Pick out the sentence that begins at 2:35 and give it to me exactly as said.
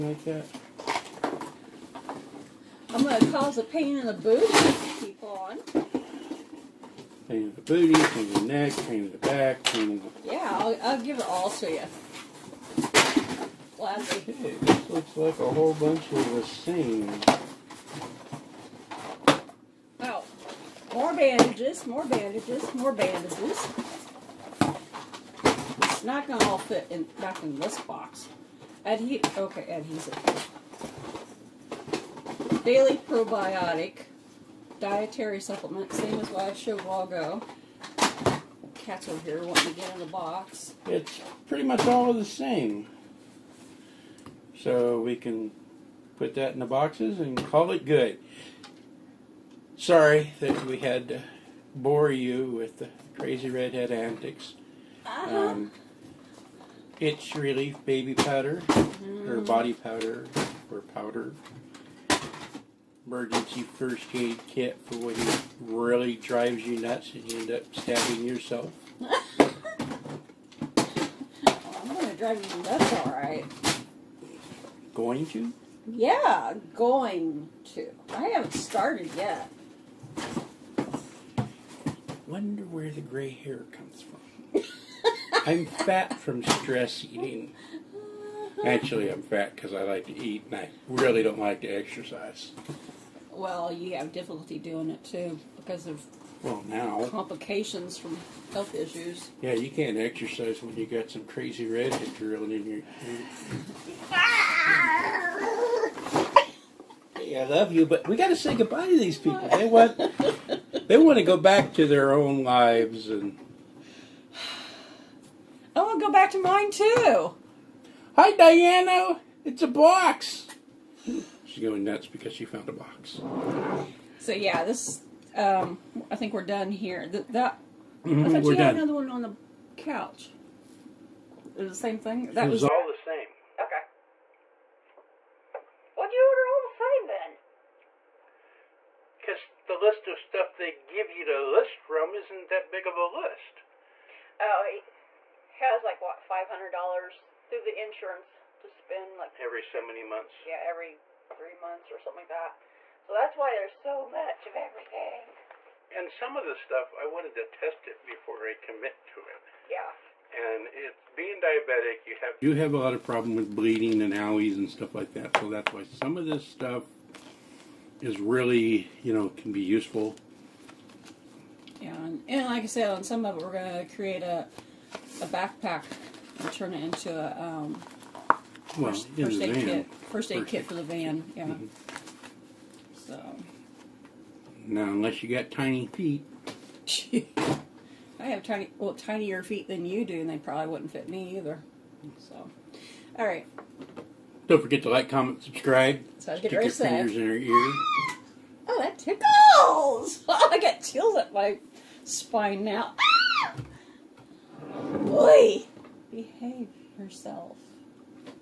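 And some of the stuff, I wanted to test it before I commit to it.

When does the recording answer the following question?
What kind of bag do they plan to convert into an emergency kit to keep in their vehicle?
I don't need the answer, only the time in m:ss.
2:55.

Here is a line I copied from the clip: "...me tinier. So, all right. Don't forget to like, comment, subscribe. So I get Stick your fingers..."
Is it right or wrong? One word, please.
wrong.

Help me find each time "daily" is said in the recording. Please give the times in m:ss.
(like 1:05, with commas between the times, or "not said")
0:32.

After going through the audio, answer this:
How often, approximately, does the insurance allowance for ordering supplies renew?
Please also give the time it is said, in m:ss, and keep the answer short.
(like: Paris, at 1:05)
Every 3 months, at 2:30.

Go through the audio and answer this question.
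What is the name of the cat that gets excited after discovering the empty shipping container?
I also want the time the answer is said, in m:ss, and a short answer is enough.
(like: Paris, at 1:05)
Diana, at 1:58.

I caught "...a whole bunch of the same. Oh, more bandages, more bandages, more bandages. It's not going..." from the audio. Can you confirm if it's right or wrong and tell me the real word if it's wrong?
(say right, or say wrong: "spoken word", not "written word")
right.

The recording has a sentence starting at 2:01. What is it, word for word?
She's going nuts because she found a box.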